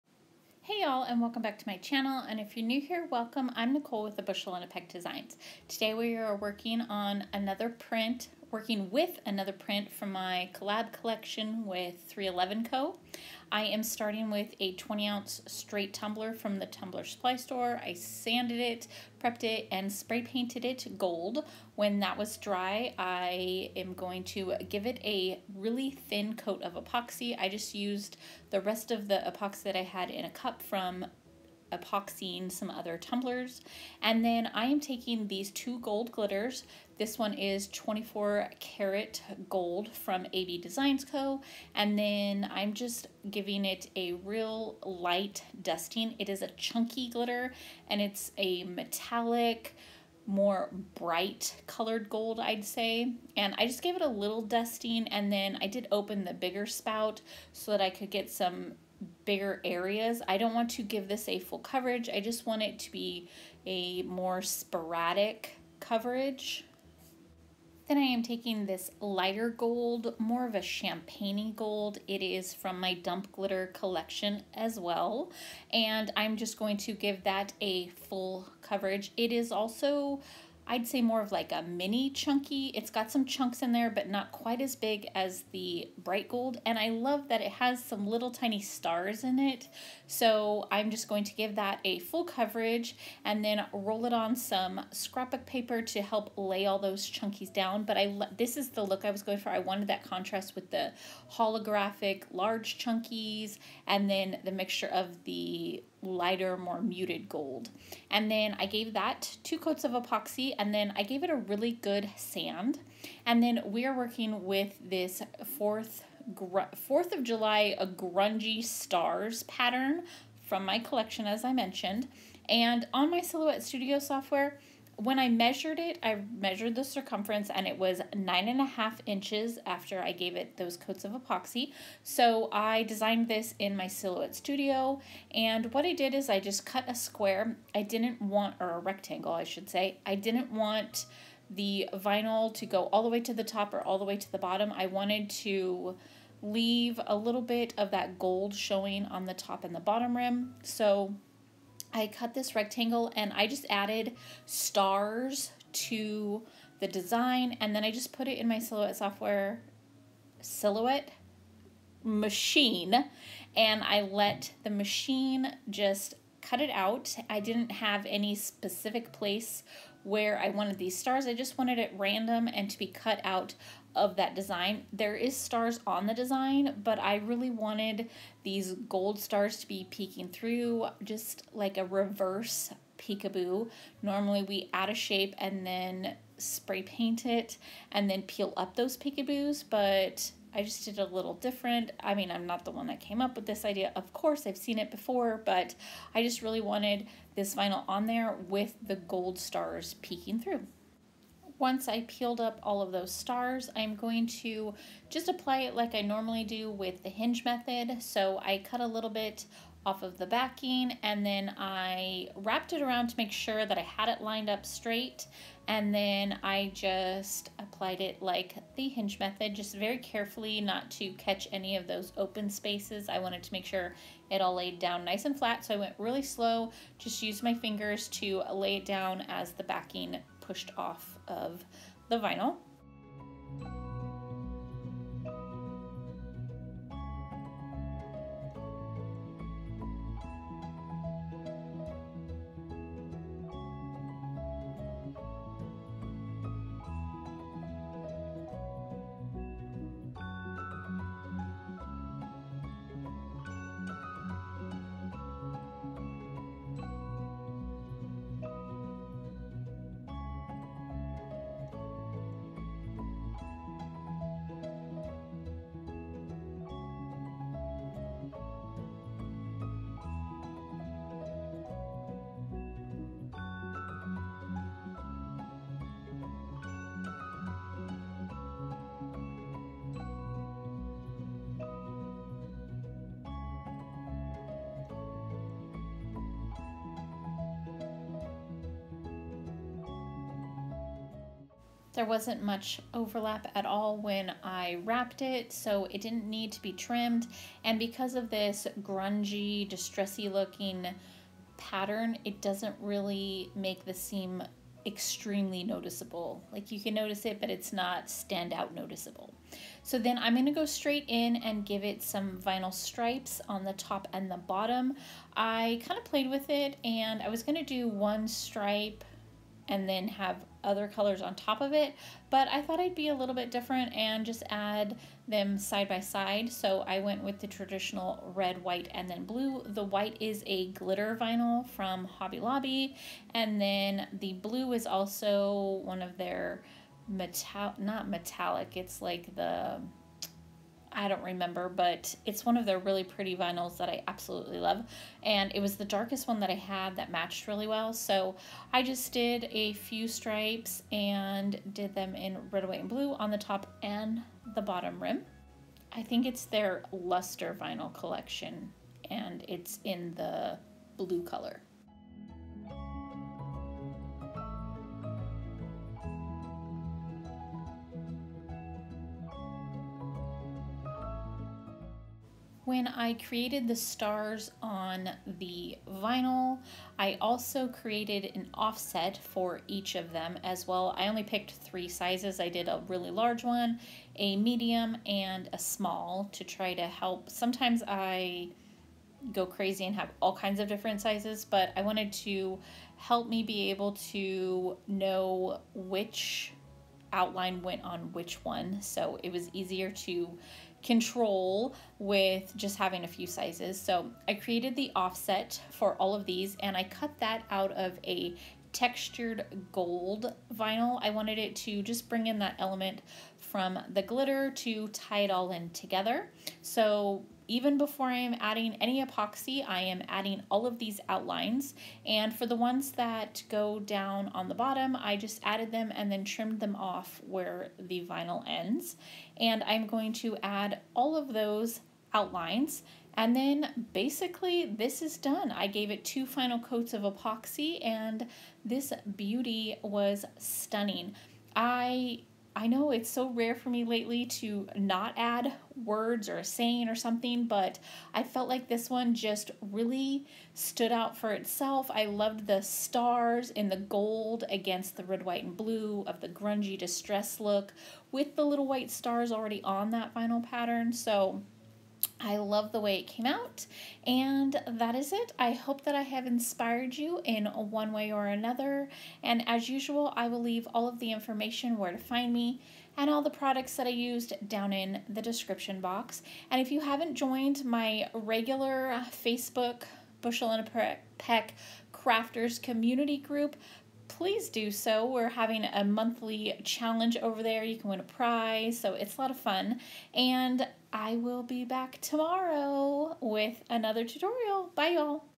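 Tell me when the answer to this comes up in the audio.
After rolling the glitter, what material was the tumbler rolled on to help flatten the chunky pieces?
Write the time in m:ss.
1:34.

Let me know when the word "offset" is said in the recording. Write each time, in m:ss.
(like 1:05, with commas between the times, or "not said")
6:18, 6:44.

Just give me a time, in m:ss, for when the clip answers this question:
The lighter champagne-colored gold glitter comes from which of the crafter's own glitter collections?
1:12.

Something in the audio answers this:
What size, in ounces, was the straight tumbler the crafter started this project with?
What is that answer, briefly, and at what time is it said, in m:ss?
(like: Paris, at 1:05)
20 ounce, at 0:14.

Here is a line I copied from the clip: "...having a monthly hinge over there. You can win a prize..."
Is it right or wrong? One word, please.
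wrong.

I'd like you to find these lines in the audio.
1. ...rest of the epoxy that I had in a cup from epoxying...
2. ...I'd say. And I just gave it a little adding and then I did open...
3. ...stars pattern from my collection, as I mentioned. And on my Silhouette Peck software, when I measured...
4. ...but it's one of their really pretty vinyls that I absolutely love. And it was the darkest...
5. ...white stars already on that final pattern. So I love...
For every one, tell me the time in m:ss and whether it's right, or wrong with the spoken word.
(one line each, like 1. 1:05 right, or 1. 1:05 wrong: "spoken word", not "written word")
1. 0:28 right
2. 0:52 wrong: "dusting", not "adding"
3. 1:58 wrong: "Studio", not "Peck"
4. 5:41 right
5. 7:38 right.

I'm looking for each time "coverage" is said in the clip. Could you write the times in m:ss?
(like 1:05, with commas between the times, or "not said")
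1:01, 1:05, 1:18, 1:32.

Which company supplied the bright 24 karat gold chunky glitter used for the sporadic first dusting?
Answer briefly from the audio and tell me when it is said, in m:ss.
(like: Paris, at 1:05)
AB Designs Co., at 0:40.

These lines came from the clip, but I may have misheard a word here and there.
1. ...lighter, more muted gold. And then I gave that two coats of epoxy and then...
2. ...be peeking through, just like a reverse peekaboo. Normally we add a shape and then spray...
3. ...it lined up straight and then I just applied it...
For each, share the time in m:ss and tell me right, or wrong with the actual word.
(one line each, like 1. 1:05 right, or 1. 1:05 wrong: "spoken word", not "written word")
1. 1:46 right
2. 2:59 right
3. 3:34 right.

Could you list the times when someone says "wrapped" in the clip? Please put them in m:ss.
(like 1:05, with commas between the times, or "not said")
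3:32, 4:54.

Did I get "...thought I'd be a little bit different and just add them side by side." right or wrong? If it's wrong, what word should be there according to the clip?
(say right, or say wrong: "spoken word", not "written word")
right.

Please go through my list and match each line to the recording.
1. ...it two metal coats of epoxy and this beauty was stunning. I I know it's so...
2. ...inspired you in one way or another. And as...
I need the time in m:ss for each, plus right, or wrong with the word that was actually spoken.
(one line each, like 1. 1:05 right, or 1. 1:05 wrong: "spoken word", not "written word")
1. 7:15 wrong: "final", not "metal"
2. 7:46 right.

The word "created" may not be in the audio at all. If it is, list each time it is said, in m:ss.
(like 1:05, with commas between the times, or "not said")
6:13, 6:17, 6:44.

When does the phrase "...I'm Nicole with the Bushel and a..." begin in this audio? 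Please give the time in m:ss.
0:03.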